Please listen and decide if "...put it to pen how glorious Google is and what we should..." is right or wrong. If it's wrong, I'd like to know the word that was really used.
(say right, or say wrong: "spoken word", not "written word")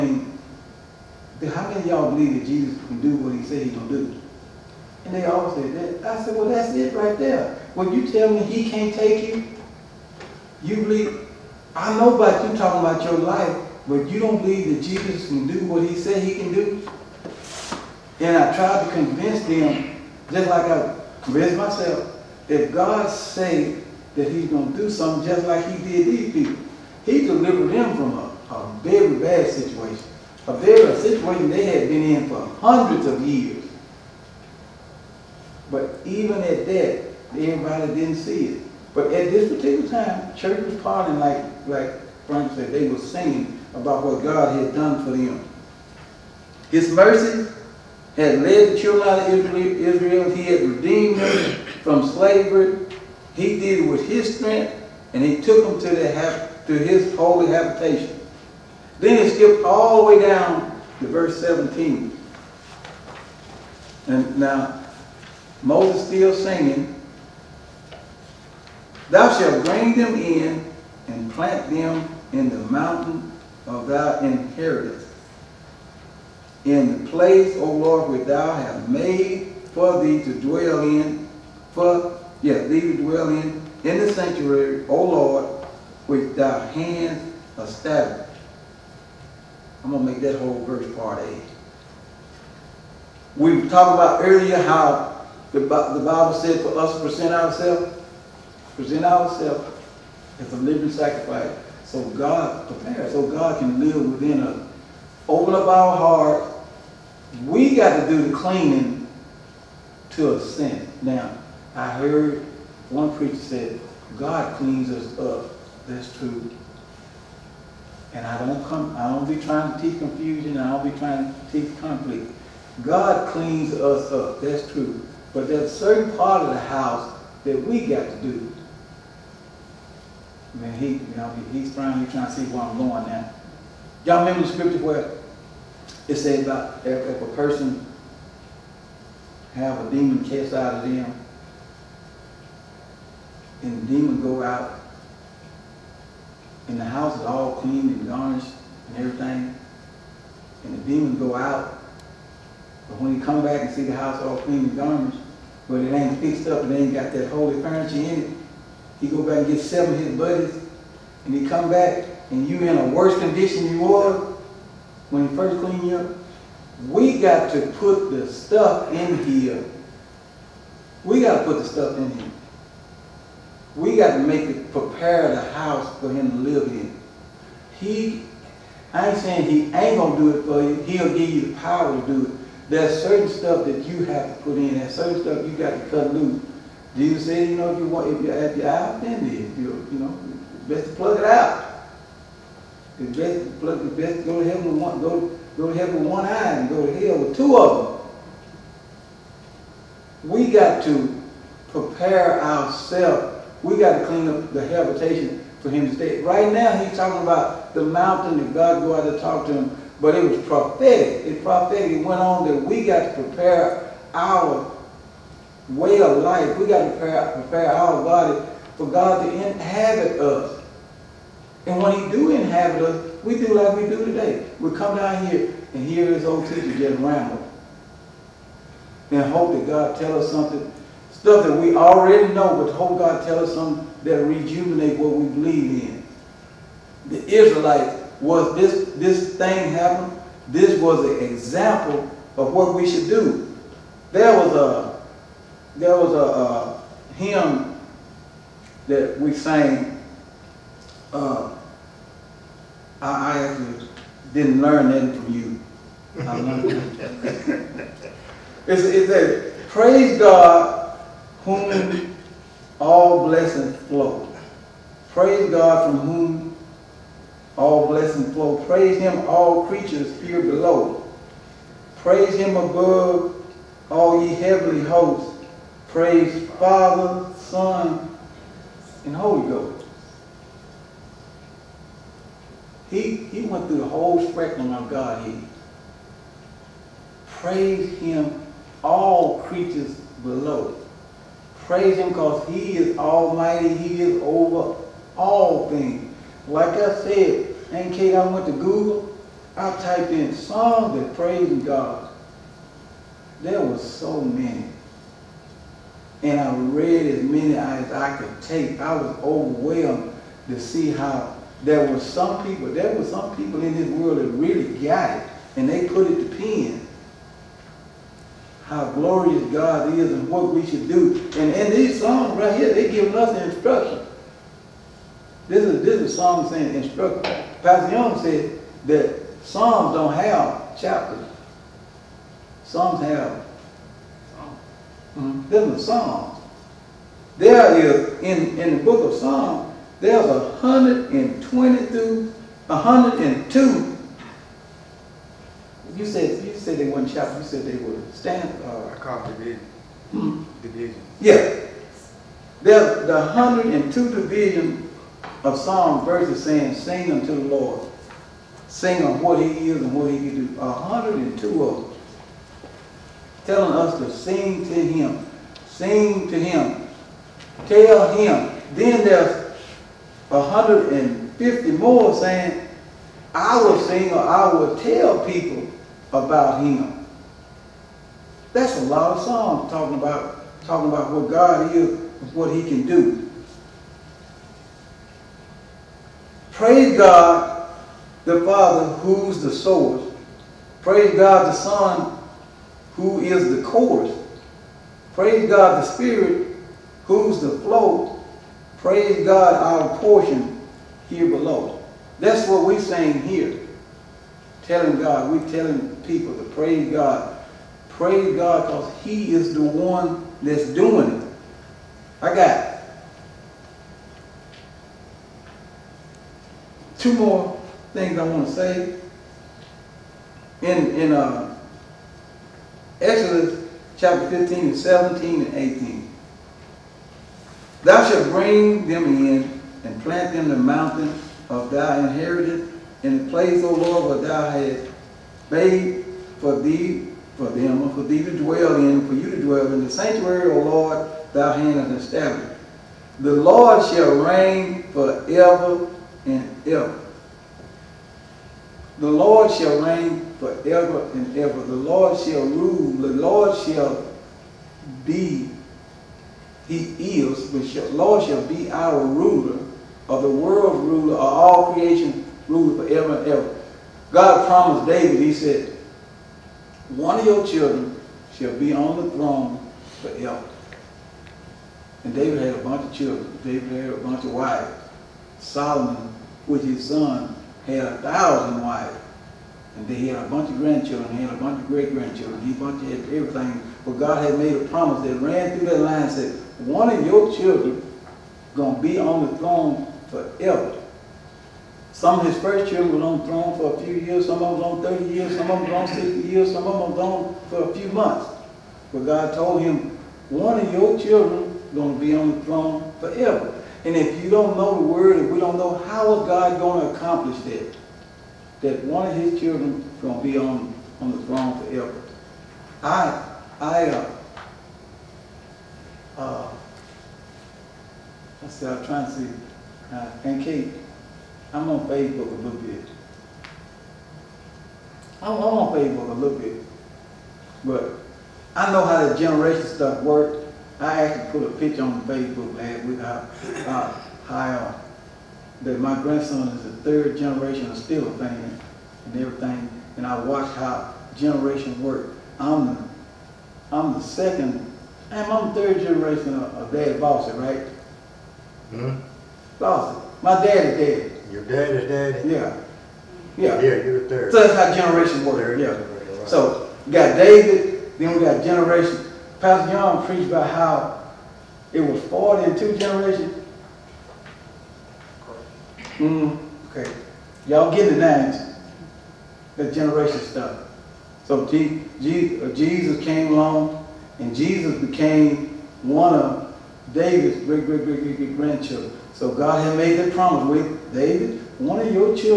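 wrong: "God", not "Google".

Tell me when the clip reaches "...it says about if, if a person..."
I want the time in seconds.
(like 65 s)
136 s.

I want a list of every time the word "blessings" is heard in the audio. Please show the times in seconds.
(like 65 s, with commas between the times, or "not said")
263 s, 267 s.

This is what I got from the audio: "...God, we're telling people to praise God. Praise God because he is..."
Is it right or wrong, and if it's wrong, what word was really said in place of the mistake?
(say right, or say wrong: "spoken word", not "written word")
right.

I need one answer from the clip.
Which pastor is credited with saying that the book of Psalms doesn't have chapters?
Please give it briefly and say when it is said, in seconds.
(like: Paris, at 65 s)
Pastor Young, at 327 s.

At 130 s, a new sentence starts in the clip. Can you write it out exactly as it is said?
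I mean, he, you know, he's finally trying to see where I'm going now.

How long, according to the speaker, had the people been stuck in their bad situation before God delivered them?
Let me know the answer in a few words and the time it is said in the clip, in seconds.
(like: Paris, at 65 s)
hundreds of years, at 32 s.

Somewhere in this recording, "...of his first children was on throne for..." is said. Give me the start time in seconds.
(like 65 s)
492 s.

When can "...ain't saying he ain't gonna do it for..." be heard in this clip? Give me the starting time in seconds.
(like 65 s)
179 s.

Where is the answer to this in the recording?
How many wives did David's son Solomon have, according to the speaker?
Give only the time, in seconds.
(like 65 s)
477 s.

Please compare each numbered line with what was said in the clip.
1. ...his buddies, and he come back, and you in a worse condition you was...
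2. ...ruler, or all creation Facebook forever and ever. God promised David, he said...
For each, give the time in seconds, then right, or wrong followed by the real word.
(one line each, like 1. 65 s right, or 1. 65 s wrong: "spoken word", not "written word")
1. 159 s right
2. 460 s wrong: "Rule", not "Facebook".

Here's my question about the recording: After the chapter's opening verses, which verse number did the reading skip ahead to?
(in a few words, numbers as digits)
17.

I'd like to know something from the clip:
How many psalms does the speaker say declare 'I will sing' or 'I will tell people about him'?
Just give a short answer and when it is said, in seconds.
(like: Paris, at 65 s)
150, at 370 s.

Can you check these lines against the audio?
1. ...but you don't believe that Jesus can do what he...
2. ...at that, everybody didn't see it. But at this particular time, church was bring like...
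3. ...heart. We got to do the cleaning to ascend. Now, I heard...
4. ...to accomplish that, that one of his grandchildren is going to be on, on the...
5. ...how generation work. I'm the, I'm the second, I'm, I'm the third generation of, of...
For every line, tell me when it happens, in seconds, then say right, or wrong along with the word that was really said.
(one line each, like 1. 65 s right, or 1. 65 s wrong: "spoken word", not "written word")
1. 13 s right
2. 36 s wrong: "partying", not "bring"
3. 105 s right
4. 506 s wrong: "children", not "grandchildren"
5. 540 s right.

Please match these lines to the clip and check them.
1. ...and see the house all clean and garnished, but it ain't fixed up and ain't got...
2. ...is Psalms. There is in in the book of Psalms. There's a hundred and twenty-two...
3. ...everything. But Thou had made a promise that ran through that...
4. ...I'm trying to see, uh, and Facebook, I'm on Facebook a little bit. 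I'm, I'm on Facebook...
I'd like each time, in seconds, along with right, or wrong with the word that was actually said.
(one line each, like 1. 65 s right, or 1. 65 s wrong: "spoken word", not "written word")
1. 153 s right
2. 335 s right
3. 483 s wrong: "God", not "Thou"
4. 518 s wrong: "Kate", not "Facebook".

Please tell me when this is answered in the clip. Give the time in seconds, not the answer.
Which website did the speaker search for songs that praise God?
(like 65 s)
298 s.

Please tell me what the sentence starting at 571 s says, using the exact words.
So uh, Jesus came along and Jesus became one of David's great, great, great, great, great grandchildren.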